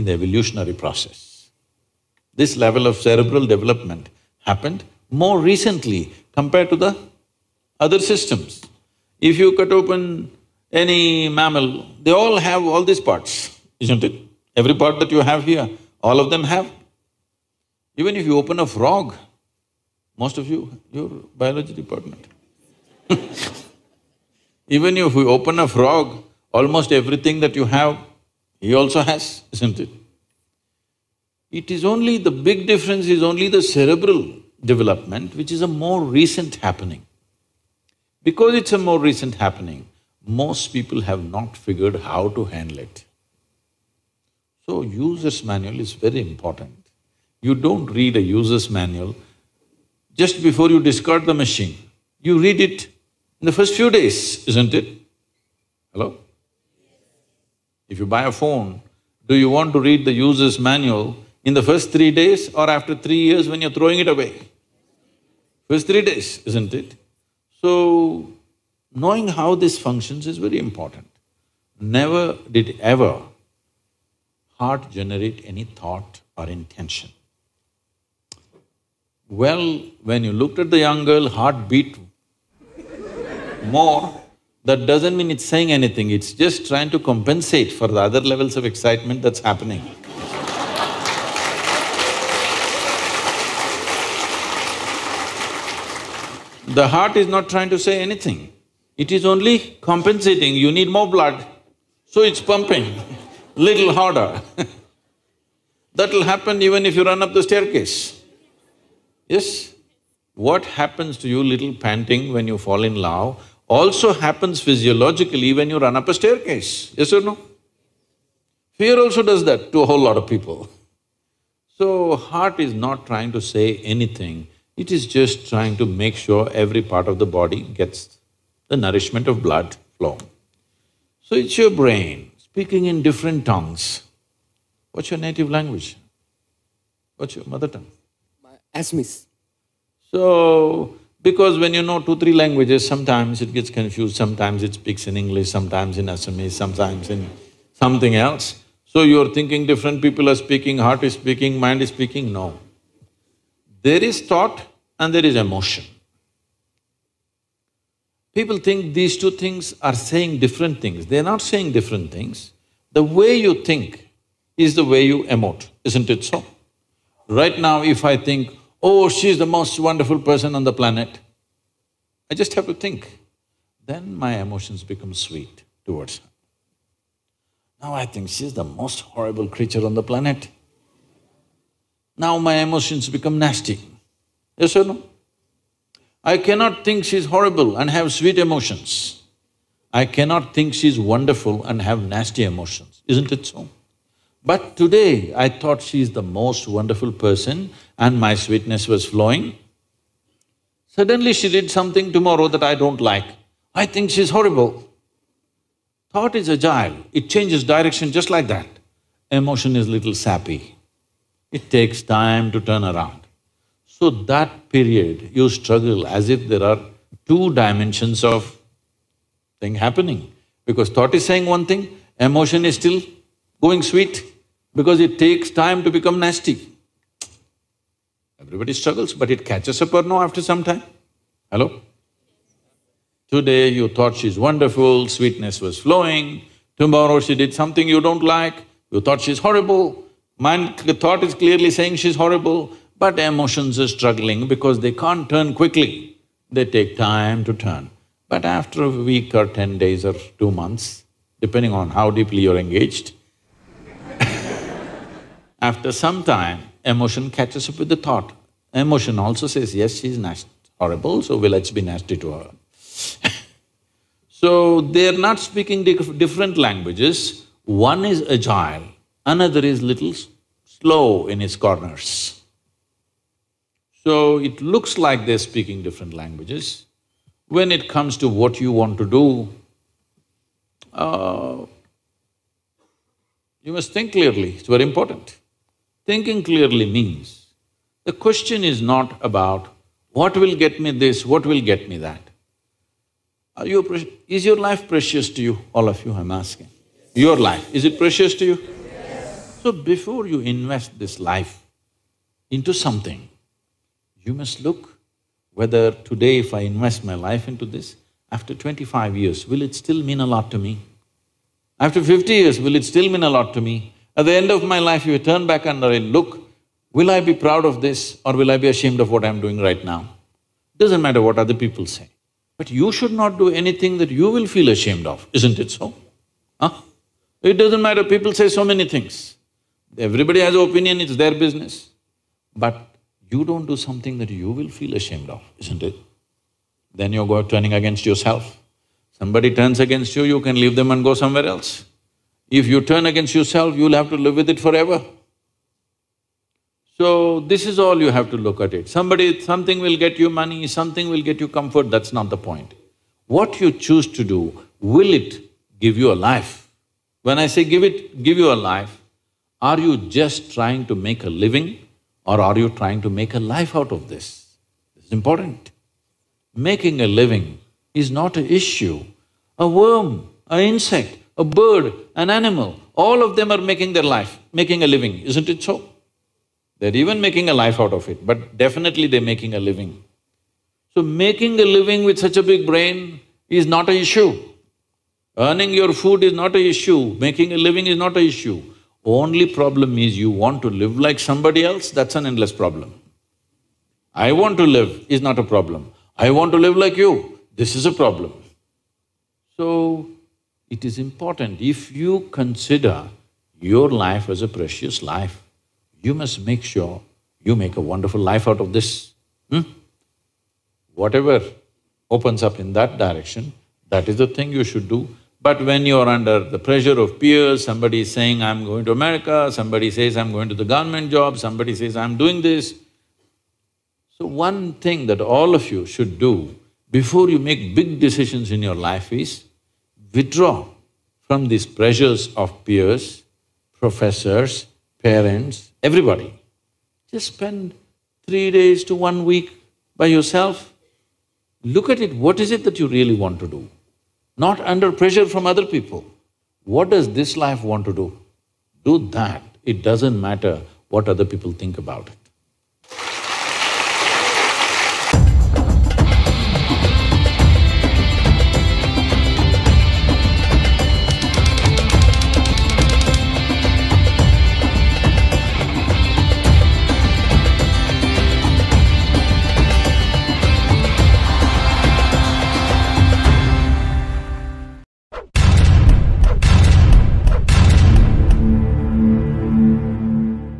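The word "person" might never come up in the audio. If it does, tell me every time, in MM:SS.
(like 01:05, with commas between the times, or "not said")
02:50, 03:17.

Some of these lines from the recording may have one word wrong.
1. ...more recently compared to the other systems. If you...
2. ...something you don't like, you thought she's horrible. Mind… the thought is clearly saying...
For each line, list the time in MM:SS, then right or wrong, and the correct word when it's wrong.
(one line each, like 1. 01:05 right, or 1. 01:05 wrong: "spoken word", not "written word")
1. 00:05 right
2. 03:57 right.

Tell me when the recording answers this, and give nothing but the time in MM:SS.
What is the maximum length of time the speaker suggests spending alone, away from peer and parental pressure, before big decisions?
07:18.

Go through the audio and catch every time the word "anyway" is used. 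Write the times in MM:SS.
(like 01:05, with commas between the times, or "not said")
not said.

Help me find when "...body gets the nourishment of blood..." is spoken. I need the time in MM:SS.
02:07.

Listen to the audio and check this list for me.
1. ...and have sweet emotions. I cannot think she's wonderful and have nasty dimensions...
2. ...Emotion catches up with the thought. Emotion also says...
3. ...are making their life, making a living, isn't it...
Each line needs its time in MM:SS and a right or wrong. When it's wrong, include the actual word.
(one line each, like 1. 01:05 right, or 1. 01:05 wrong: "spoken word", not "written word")
1. 03:07 wrong: "emotions", not "dimensions"
2. 04:16 right
3. 06:13 right.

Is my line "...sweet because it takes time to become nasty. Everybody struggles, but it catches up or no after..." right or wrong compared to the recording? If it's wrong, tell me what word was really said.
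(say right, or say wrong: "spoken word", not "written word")
right.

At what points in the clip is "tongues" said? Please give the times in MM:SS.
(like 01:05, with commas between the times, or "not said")
02:13, 02:17.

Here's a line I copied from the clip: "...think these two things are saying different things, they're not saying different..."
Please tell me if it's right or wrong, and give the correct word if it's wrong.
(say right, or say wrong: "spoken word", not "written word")
right.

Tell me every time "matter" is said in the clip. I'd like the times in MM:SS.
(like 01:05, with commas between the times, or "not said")
05:21, 05:27, 07:30.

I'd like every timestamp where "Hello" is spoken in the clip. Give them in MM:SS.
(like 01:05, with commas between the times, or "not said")
00:55, 03:51.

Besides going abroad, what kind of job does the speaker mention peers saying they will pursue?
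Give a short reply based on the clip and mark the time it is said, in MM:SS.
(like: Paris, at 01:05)
government job, at 07:00.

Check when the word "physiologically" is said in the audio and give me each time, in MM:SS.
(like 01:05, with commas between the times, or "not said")
01:54.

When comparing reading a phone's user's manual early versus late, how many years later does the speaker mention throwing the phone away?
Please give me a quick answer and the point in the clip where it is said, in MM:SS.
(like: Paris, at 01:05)
3, at 01:02.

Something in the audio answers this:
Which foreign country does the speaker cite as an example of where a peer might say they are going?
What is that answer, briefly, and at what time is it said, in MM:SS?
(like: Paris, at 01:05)
America, at 06:58.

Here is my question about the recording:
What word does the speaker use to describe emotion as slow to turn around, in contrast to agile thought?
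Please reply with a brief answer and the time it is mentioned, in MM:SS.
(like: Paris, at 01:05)
sappy, at 03:30.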